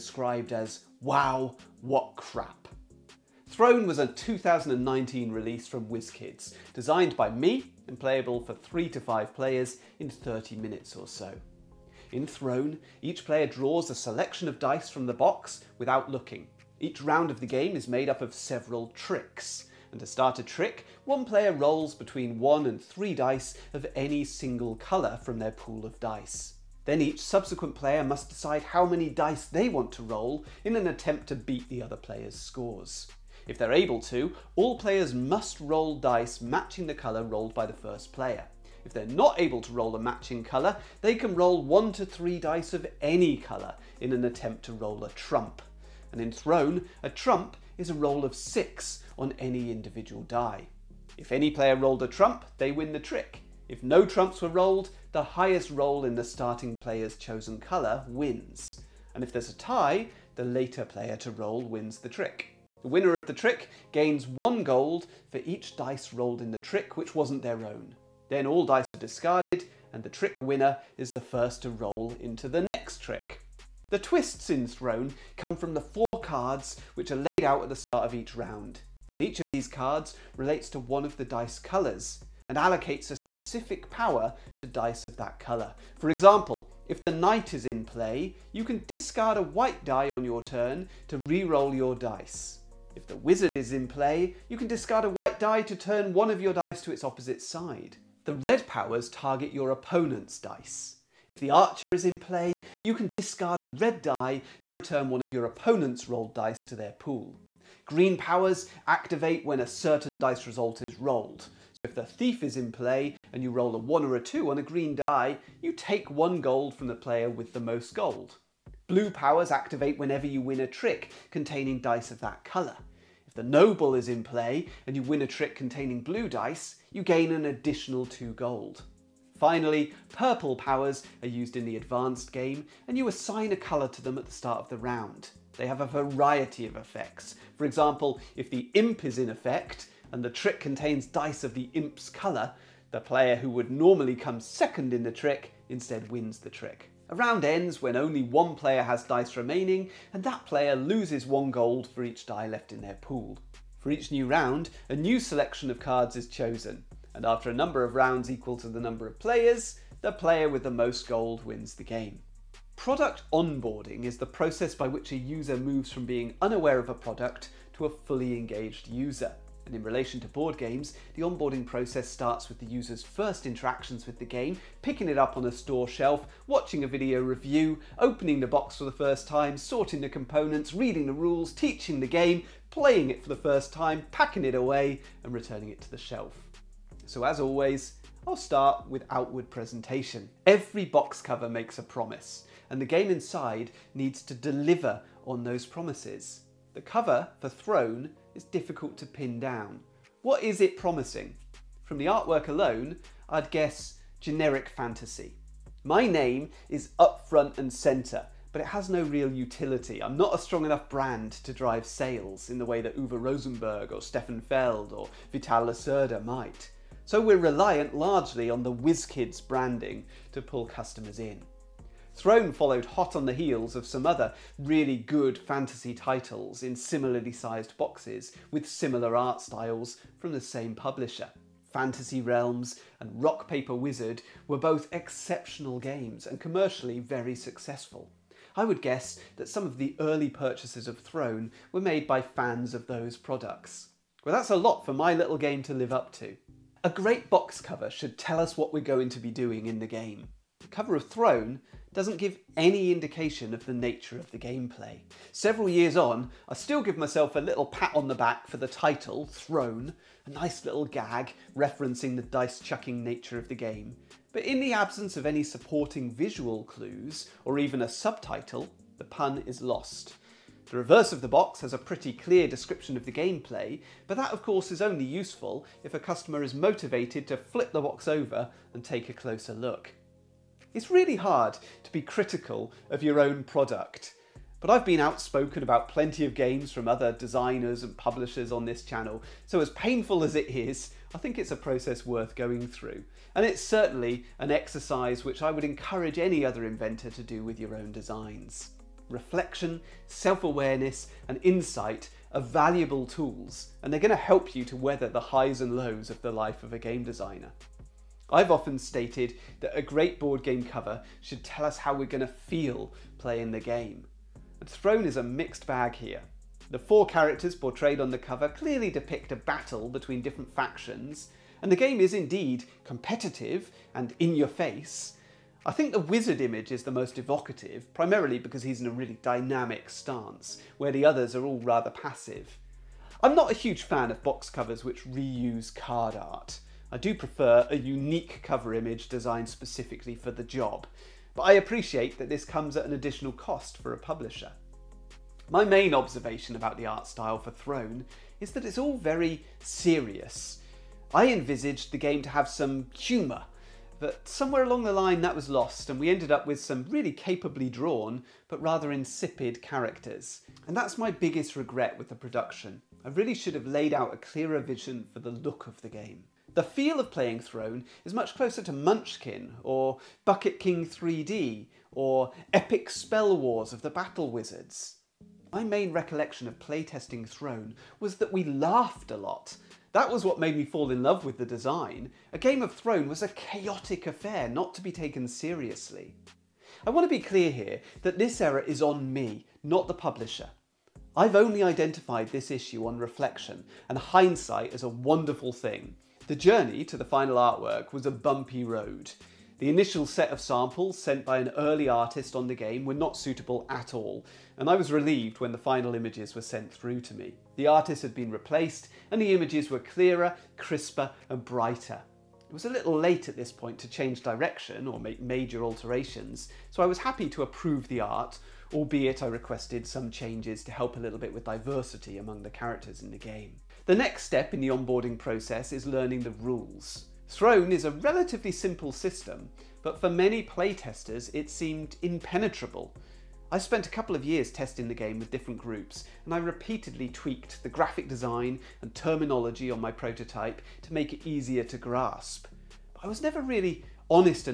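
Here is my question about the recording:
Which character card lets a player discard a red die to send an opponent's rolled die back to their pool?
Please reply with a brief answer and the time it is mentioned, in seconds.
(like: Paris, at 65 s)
the archer, at 101 s.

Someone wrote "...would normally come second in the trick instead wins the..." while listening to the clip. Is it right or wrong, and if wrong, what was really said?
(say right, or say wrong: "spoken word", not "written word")
right.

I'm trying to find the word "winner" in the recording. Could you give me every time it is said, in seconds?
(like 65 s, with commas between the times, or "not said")
62 s, 70 s.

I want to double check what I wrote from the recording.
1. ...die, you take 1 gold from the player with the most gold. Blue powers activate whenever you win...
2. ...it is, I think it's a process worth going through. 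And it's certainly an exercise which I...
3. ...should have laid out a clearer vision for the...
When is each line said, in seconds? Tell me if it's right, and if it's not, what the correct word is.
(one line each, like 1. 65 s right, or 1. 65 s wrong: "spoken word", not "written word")
1. 114 s right
2. 290 s right
3. 363 s right.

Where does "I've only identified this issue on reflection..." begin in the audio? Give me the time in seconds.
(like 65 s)
391 s.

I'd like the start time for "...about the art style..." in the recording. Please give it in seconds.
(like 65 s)
346 s.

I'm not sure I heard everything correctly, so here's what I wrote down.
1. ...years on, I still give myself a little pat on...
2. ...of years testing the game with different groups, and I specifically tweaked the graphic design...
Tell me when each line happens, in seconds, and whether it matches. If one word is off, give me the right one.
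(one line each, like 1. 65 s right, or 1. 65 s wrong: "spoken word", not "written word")
1. 255 s right
2. 434 s wrong: "repeatedly", not "specifically".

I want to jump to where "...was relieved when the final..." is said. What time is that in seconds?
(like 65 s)
404 s.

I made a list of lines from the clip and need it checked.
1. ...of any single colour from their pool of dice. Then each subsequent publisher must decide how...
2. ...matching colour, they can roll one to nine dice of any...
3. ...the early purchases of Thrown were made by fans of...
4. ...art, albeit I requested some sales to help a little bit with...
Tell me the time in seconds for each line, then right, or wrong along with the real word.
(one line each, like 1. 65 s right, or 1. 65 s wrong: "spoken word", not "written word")
1. 23 s wrong: "player", not "publisher"
2. 39 s wrong: "three", not "nine"
3. 239 s right
4. 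417 s wrong: "changes", not "sales".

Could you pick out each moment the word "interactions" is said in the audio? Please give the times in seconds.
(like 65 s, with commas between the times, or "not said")
173 s.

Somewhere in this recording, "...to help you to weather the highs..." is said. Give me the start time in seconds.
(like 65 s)
304 s.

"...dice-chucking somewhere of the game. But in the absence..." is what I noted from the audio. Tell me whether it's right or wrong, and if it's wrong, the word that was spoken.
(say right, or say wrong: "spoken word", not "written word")
wrong: "nature", not "somewhere".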